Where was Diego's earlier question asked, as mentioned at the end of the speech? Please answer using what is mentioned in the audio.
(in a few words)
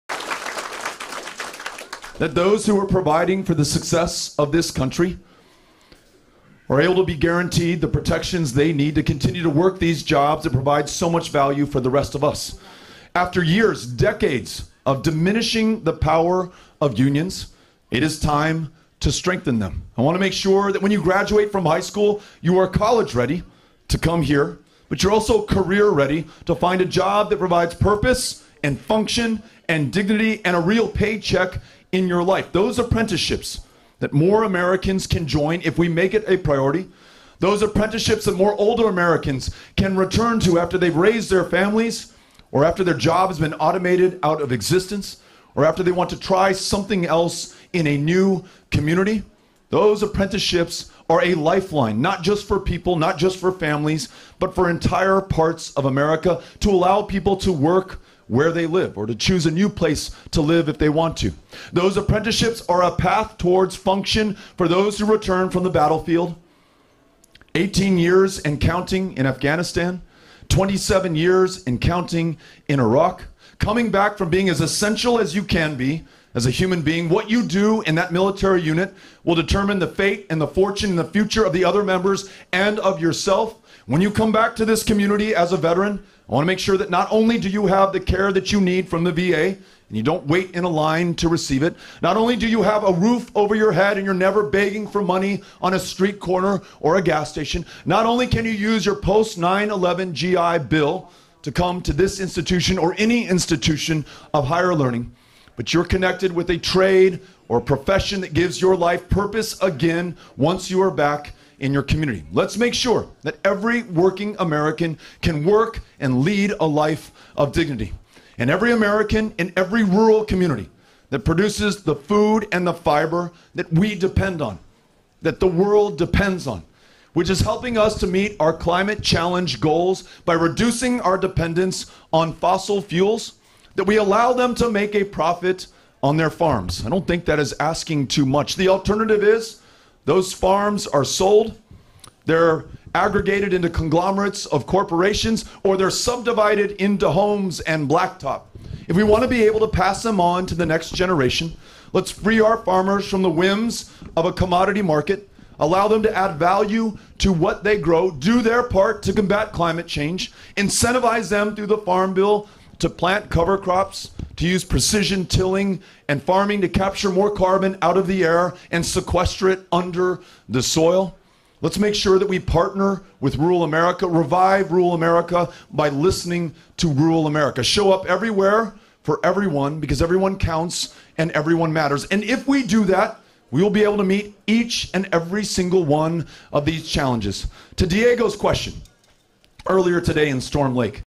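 Storm Lake.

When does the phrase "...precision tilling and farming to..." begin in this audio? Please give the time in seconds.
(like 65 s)
164 s.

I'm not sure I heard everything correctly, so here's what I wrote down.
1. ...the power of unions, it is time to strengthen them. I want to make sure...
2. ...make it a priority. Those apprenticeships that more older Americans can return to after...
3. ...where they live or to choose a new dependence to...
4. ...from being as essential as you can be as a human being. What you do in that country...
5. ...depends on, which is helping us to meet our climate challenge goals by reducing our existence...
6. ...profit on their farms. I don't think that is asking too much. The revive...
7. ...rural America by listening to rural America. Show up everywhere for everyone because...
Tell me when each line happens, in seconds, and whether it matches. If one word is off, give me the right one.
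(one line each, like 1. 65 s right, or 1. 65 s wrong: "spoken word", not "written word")
1. 15 s right
2. 35 s right
3. 58 s wrong: "place", not "dependence"
4. 74 s wrong: "military", not "country"
5. 125 s wrong: "dependence", not "existence"
6. 135 s wrong: "alternative", not "revive"
7. 174 s right.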